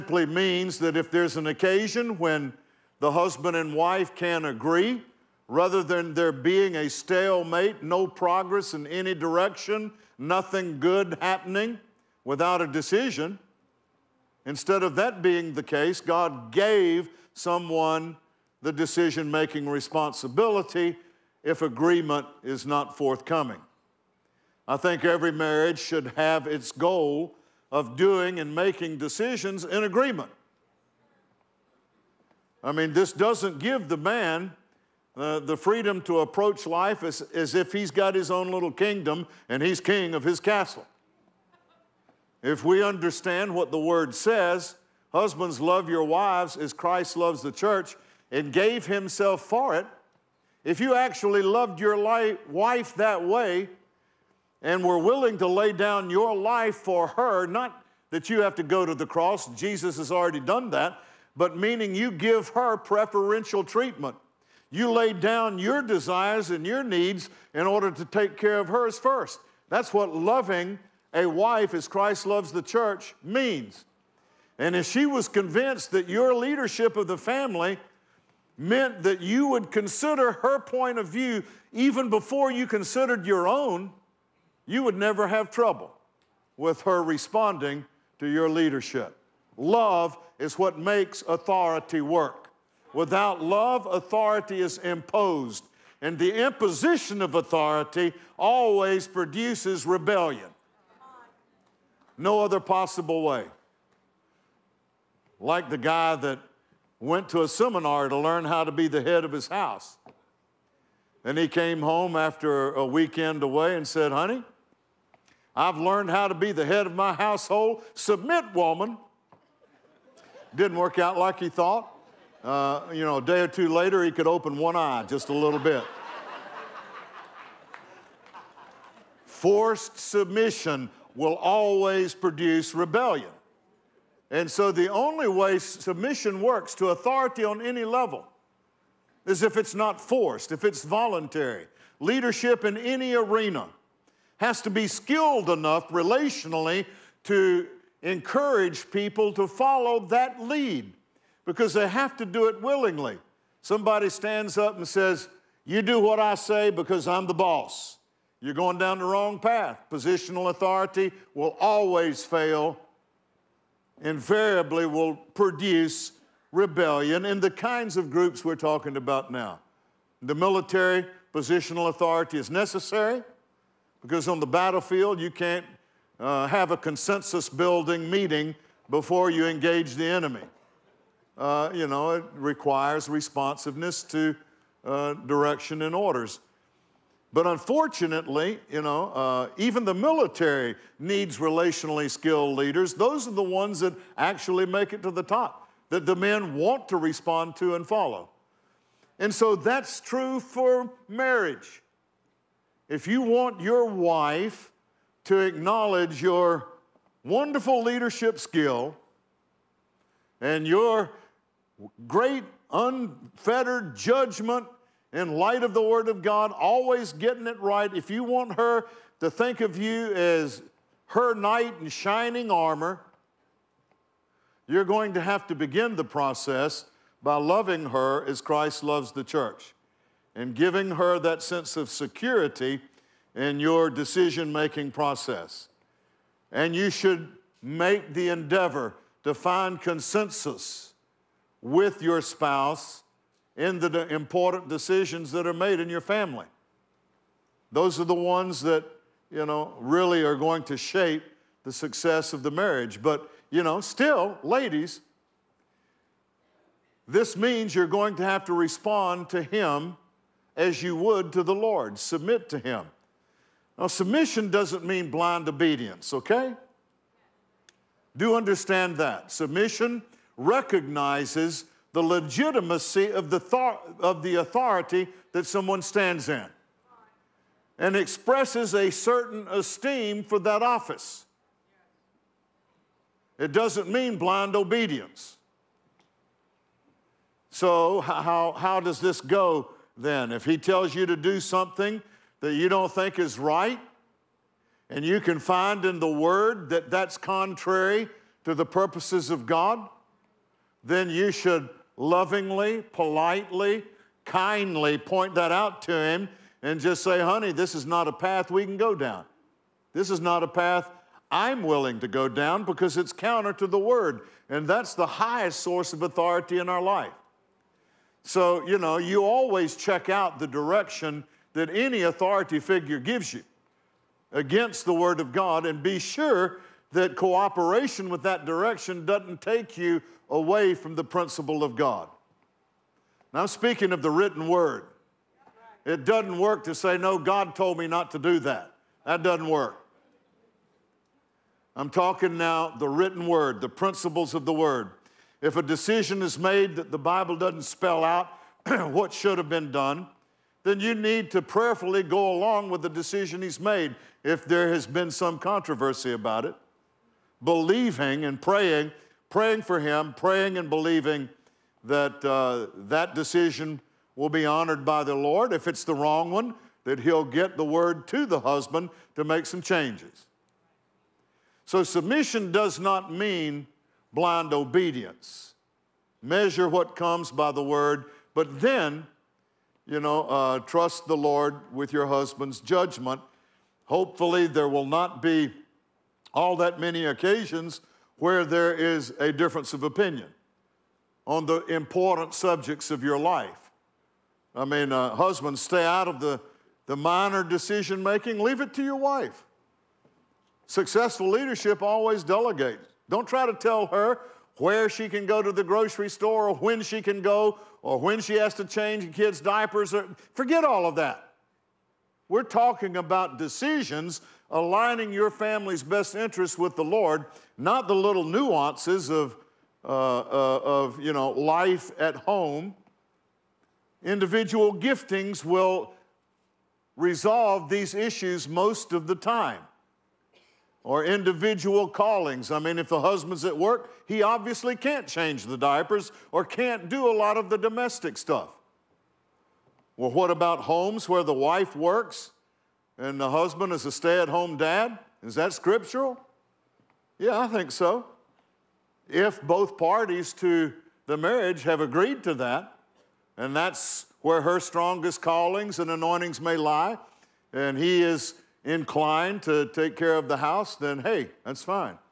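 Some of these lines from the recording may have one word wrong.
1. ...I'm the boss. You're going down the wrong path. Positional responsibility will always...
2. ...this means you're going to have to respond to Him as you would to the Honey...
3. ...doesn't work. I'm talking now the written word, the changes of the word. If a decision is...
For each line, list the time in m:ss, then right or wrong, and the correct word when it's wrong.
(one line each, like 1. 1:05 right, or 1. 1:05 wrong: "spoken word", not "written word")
1. 2:37 wrong: "authority", not "responsibility"
2. 4:17 wrong: "Lord", not "Honey"
3. 5:39 wrong: "principles", not "changes".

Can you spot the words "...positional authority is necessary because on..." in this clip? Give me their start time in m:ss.
2:51.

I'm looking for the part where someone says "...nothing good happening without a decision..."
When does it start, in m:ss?
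0:10.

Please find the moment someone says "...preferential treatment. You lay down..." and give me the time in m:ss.
1:02.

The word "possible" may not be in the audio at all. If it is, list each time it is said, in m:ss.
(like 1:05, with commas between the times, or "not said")
1:42.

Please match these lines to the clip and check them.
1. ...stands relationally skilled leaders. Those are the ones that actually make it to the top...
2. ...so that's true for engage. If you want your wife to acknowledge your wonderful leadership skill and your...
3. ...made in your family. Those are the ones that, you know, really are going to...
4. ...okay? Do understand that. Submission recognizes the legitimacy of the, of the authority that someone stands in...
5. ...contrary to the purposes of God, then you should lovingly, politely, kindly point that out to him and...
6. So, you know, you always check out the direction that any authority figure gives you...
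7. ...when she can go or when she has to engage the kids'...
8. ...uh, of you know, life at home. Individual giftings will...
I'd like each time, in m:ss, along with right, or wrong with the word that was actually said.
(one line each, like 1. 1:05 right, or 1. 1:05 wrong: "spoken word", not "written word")
1. 3:10 wrong: "needs", not "stands"
2. 3:19 wrong: "marriage", not "engage"
3. 4:05 right
4. 4:26 right
5. 4:57 right
6. 5:18 right
7. 6:46 wrong: "change", not "engage"
8. 7:00 right.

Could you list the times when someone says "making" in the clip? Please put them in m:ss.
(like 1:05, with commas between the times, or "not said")
0:19, 0:28, 3:54, 6:38.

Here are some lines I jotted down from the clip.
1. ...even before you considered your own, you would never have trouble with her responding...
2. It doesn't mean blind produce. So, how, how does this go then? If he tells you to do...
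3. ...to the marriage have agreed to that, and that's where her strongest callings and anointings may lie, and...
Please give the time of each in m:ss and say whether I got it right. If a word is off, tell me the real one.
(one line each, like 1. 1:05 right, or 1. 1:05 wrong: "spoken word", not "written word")
1. 1:21 right
2. 4:43 wrong: "obedience", not "produce"
3. 7:30 right.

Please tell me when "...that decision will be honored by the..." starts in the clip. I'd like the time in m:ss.
6:02.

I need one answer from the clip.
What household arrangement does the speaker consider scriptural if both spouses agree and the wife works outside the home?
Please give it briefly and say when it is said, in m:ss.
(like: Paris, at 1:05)
Stay at home dad, at 7:23.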